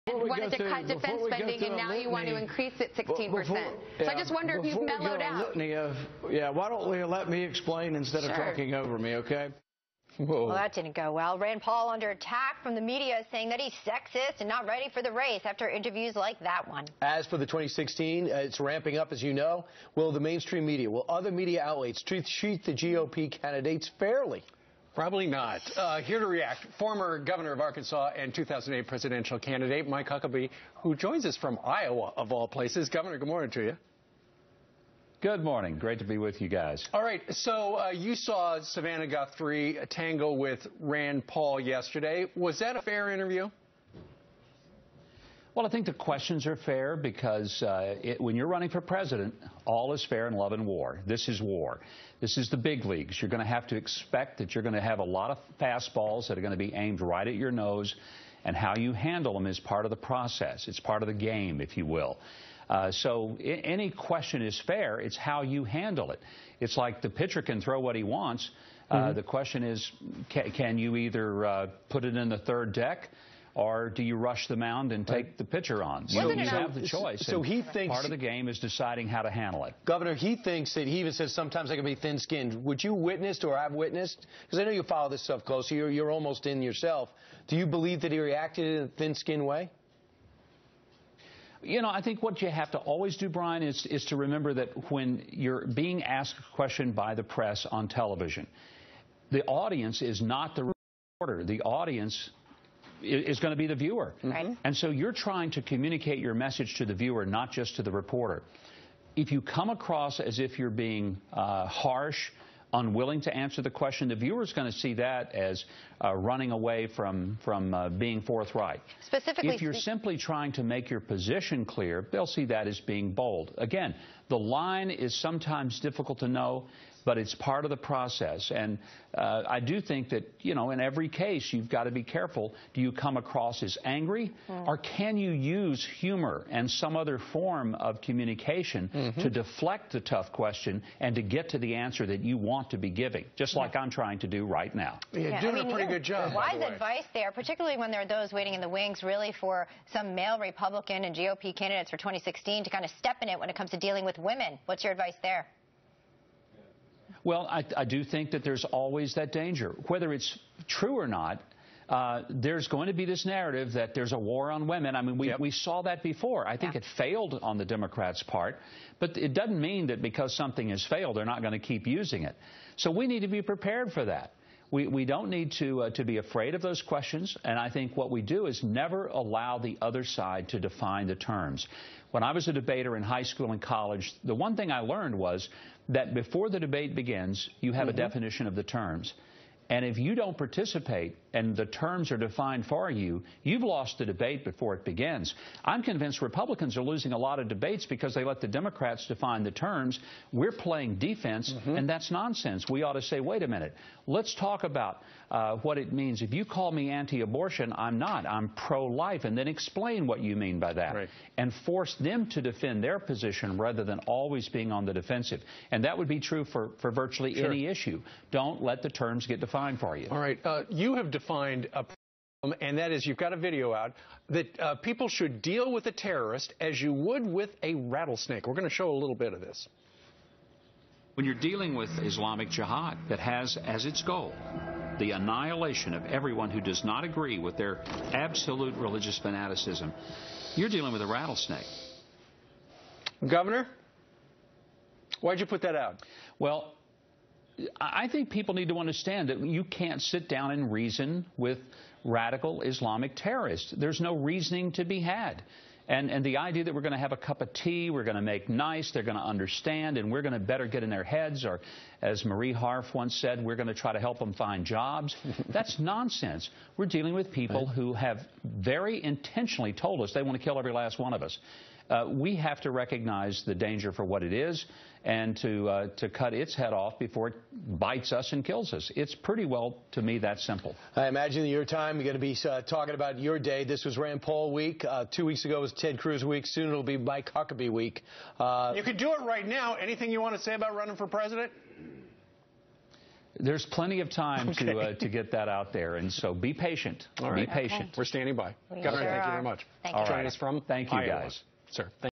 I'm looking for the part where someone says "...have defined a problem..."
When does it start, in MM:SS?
03:40.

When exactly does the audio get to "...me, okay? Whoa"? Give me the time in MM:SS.
00:08.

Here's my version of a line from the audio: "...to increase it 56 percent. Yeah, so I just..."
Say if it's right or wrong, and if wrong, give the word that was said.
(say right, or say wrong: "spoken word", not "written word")
wrong: "16", not "56".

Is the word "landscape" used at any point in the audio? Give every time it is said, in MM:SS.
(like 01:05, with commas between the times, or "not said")
not said.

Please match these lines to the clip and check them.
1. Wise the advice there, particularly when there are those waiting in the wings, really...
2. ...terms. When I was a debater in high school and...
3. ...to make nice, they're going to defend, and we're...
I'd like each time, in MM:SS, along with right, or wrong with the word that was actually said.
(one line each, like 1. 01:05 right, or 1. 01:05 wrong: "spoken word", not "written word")
1. 02:26 right
2. 03:01 right
3. 04:18 wrong: "understand", not "defend".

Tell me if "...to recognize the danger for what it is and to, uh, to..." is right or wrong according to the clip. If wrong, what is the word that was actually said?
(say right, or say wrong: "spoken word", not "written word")
right.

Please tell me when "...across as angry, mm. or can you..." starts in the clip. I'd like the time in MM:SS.
02:13.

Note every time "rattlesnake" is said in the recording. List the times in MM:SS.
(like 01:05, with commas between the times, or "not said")
03:47, 04:01.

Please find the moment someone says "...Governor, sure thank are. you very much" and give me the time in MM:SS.
04:58.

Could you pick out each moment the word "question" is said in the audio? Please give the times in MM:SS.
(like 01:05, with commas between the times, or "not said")
00:45, 01:03, 01:09, 01:36, 01:53, 02:20, 02:56.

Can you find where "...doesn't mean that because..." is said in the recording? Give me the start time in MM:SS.
02:49.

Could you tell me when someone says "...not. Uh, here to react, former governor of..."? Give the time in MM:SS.
00:25.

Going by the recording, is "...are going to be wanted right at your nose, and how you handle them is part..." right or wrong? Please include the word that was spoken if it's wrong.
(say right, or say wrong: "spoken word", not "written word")
wrong: "aimed", not "wanted".